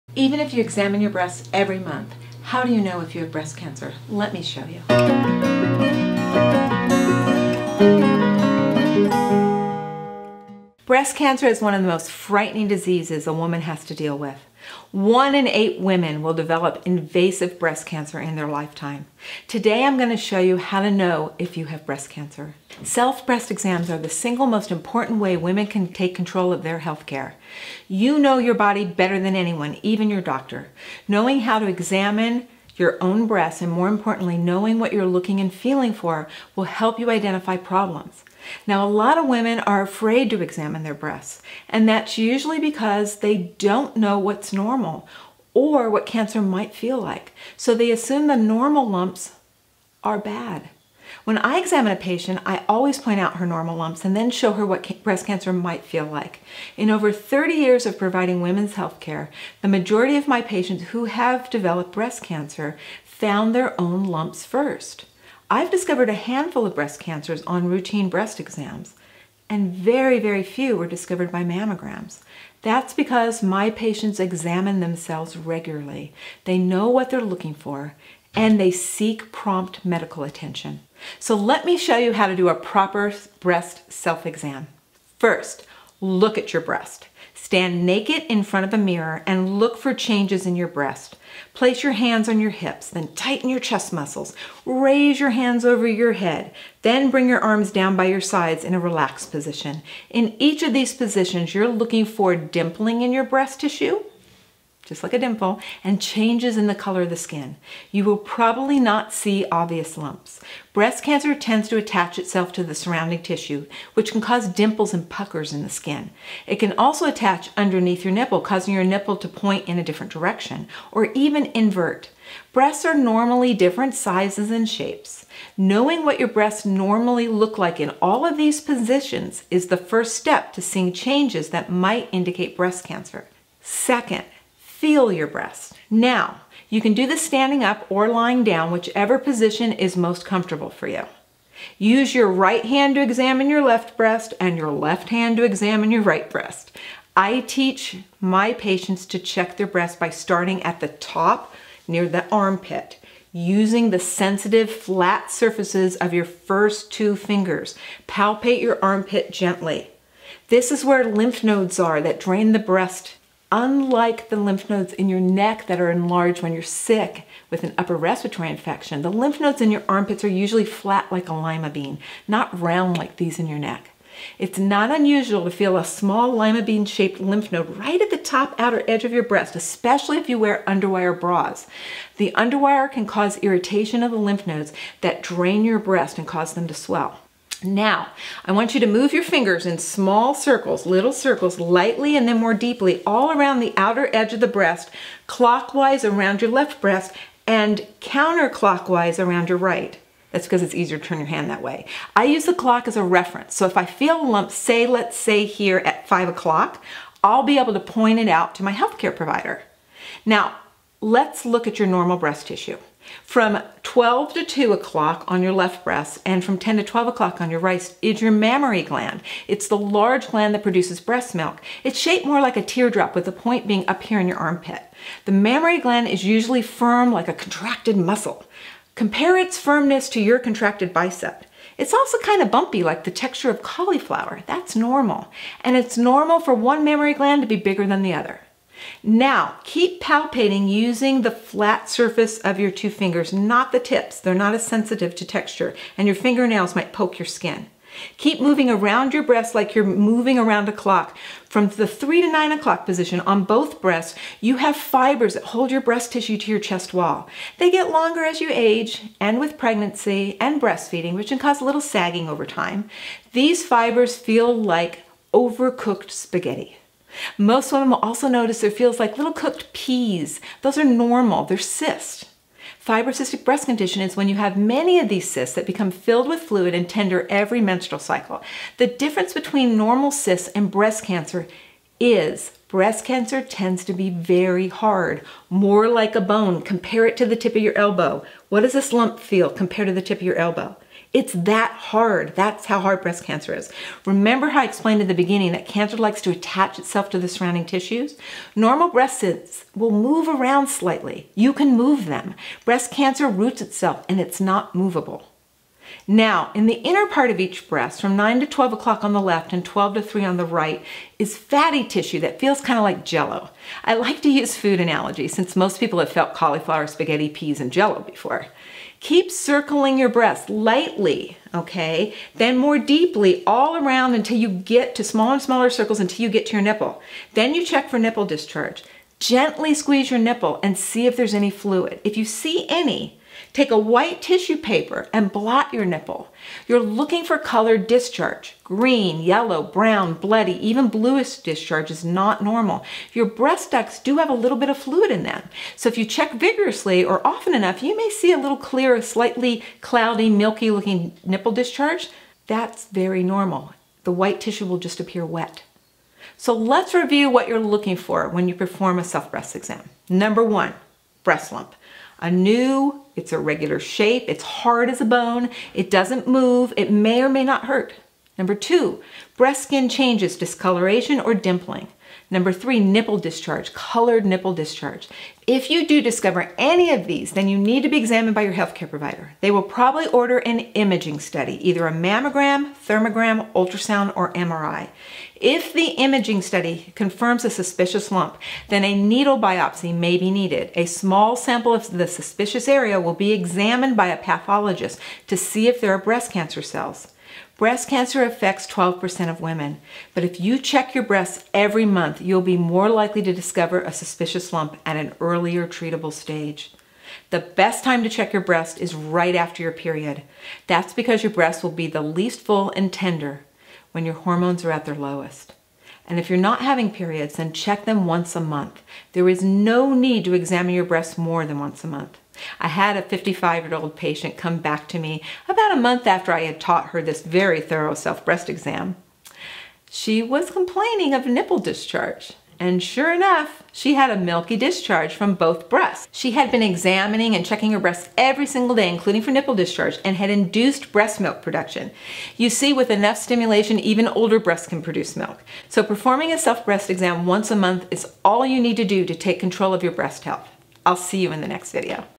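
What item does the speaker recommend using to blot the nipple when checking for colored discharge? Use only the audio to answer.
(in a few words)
white tissue paper.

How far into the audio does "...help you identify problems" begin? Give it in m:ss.
0:36.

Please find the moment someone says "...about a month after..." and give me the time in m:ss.
7:05.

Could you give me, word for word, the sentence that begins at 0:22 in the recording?
Self-breast exams are the single most important way women can take control of their health care.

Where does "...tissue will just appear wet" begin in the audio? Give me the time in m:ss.
5:54.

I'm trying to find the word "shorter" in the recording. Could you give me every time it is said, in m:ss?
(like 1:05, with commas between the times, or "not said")
not said.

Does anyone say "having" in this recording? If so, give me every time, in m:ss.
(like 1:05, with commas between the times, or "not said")
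6:56.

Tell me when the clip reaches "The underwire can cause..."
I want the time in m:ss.
3:02.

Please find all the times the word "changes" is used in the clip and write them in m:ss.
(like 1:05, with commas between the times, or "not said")
1:29, 1:46, 2:10, 6:09.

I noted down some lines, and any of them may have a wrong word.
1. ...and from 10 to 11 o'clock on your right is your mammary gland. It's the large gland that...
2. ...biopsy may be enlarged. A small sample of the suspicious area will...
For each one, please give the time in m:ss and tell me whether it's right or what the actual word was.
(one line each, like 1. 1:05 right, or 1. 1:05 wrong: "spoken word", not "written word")
1. 3:36 wrong: "12", not "11"
2. 6:29 wrong: "needed", not "enlarged".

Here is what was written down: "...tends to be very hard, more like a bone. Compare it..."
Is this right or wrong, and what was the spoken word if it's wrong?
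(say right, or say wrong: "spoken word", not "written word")
right.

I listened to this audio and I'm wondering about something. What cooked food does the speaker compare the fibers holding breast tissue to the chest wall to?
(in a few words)
overcooked spaghetti.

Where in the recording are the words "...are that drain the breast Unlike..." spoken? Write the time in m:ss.
2:41.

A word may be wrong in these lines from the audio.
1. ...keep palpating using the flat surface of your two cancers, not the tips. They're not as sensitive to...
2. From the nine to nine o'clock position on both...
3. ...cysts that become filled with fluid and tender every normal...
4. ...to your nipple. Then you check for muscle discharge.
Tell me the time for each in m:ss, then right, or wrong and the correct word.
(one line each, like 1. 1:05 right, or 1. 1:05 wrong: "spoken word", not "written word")
1. 3:59 wrong: "fingers", not "cancers"
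2. 4:11 wrong: "three", not "nine"
3. 4:35 wrong: "menstrual", not "normal"
4. 5:26 wrong: "nipple", not "muscle".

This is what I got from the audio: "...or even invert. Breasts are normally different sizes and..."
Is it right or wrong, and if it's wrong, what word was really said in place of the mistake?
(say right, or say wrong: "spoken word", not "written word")
right.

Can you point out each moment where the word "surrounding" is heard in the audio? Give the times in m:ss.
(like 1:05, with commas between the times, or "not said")
1:52, 4:57.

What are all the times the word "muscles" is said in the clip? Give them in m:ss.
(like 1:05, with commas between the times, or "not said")
1:33, 3:47.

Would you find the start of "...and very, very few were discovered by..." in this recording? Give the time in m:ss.
1:09.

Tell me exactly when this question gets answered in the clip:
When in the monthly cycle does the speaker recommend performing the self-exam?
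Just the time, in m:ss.
6:48.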